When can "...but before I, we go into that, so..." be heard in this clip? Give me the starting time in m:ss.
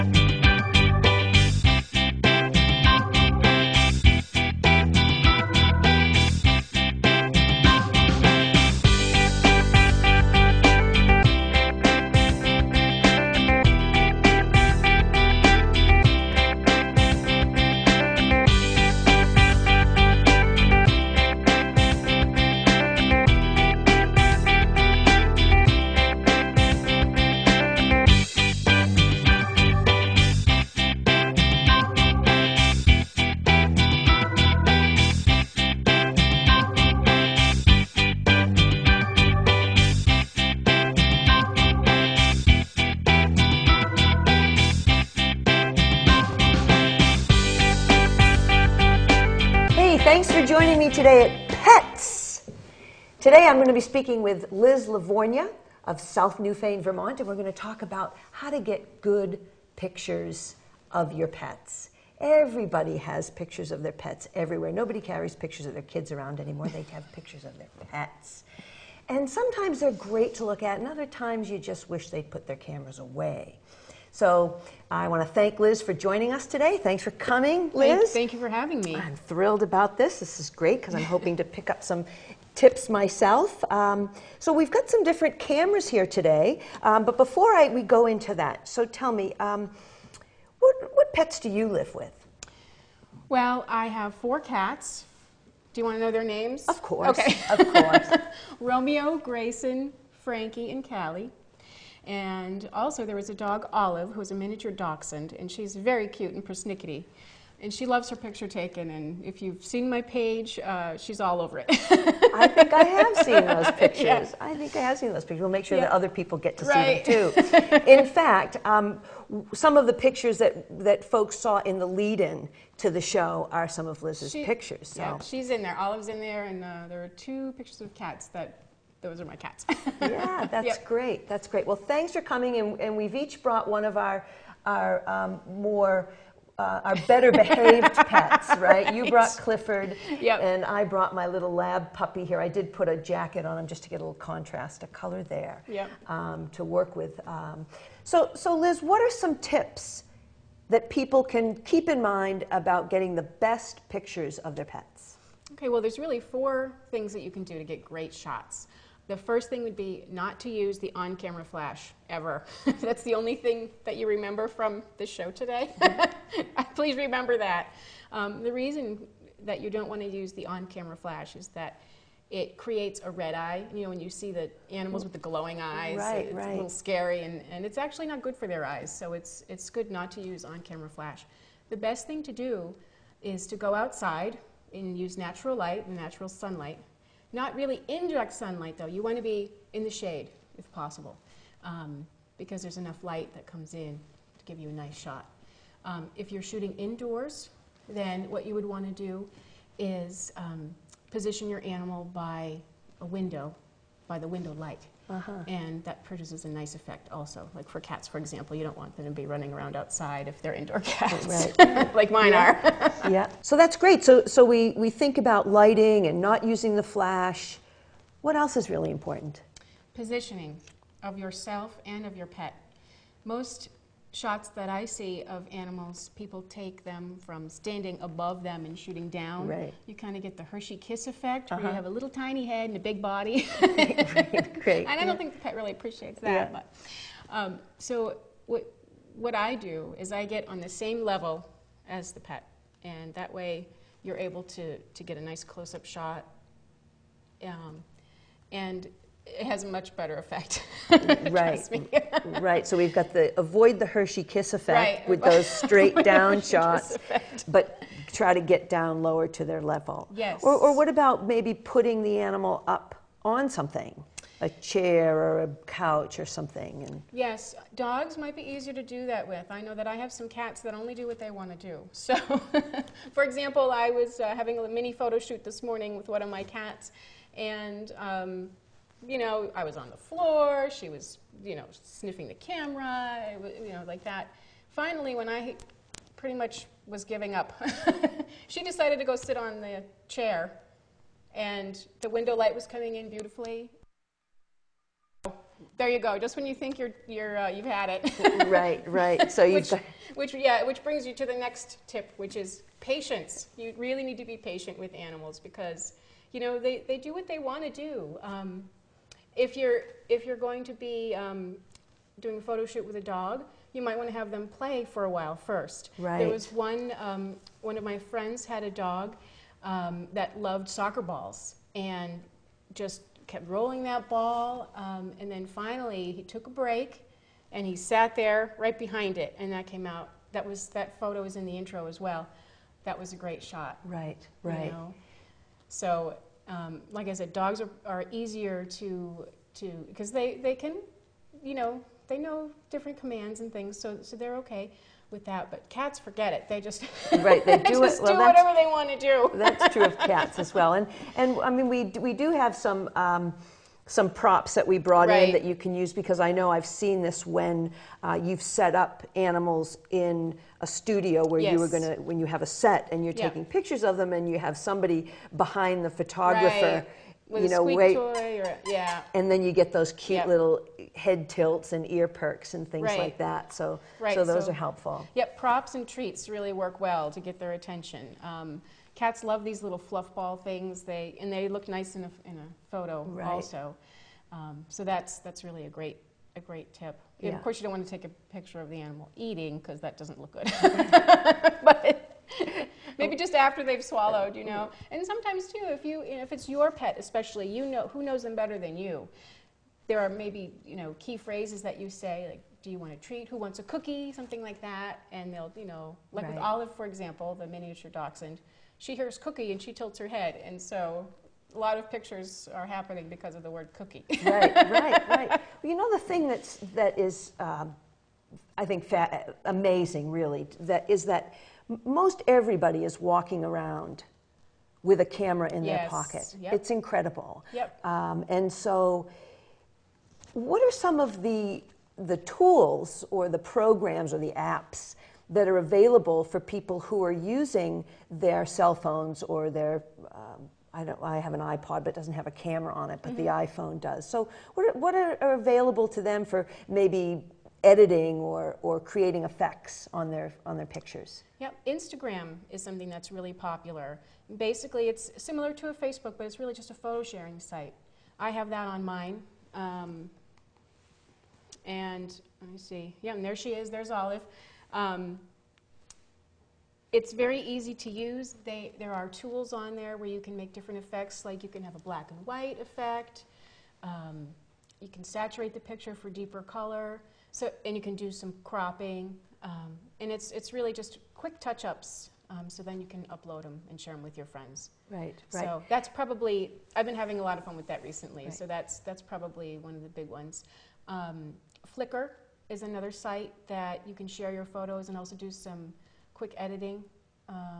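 1:27.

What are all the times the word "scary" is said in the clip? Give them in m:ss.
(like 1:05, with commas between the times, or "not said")
2:56.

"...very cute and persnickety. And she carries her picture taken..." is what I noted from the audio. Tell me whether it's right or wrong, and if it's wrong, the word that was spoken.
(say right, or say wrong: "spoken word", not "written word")
wrong: "loves", not "carries".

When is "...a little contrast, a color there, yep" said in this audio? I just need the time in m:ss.
2:23.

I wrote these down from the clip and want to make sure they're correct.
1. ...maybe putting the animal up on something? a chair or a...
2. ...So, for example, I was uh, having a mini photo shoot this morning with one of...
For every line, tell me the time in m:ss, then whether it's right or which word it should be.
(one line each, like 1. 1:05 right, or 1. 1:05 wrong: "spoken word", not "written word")
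1. 4:21 right
2. 4:31 right.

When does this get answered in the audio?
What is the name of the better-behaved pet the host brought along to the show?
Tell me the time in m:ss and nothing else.
2:19.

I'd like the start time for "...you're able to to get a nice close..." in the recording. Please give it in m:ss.
4:04.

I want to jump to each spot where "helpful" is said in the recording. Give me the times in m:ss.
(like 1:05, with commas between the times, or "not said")
6:14.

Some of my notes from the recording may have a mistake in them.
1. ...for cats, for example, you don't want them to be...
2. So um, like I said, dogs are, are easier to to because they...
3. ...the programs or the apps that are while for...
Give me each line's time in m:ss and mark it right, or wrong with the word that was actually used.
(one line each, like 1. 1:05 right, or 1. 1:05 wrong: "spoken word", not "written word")
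1. 3:27 right
2. 5:35 right
3. 7:13 wrong: "available", not "while".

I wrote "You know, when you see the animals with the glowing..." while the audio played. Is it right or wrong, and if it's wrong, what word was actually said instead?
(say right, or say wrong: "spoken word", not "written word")
right.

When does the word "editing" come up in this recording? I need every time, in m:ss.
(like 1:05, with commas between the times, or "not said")
7:27, 8:16.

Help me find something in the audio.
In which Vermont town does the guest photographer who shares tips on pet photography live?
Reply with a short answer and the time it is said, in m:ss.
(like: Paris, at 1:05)
South Newfane, at 0:55.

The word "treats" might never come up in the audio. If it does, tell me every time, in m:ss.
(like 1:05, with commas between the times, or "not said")
6:15, 6:42.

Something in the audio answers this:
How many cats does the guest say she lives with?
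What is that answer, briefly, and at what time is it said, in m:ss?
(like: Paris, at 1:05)
4, at 1:34.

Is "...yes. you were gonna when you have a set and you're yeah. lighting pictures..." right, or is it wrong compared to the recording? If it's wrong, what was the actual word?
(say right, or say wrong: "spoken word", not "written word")
wrong: "taking", not "lighting".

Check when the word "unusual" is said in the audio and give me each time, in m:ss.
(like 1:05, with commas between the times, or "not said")
not said.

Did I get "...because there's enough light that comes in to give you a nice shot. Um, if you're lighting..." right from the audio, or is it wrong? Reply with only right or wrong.
wrong.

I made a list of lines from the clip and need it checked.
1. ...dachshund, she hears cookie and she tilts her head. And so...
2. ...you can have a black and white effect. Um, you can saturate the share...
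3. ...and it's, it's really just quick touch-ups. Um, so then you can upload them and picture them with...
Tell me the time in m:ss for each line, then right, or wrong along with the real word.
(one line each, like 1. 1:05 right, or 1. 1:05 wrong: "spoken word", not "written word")
1. 6:47 right
2. 7:51 wrong: "picture", not "share"
3. 7:59 wrong: "share", not "picture".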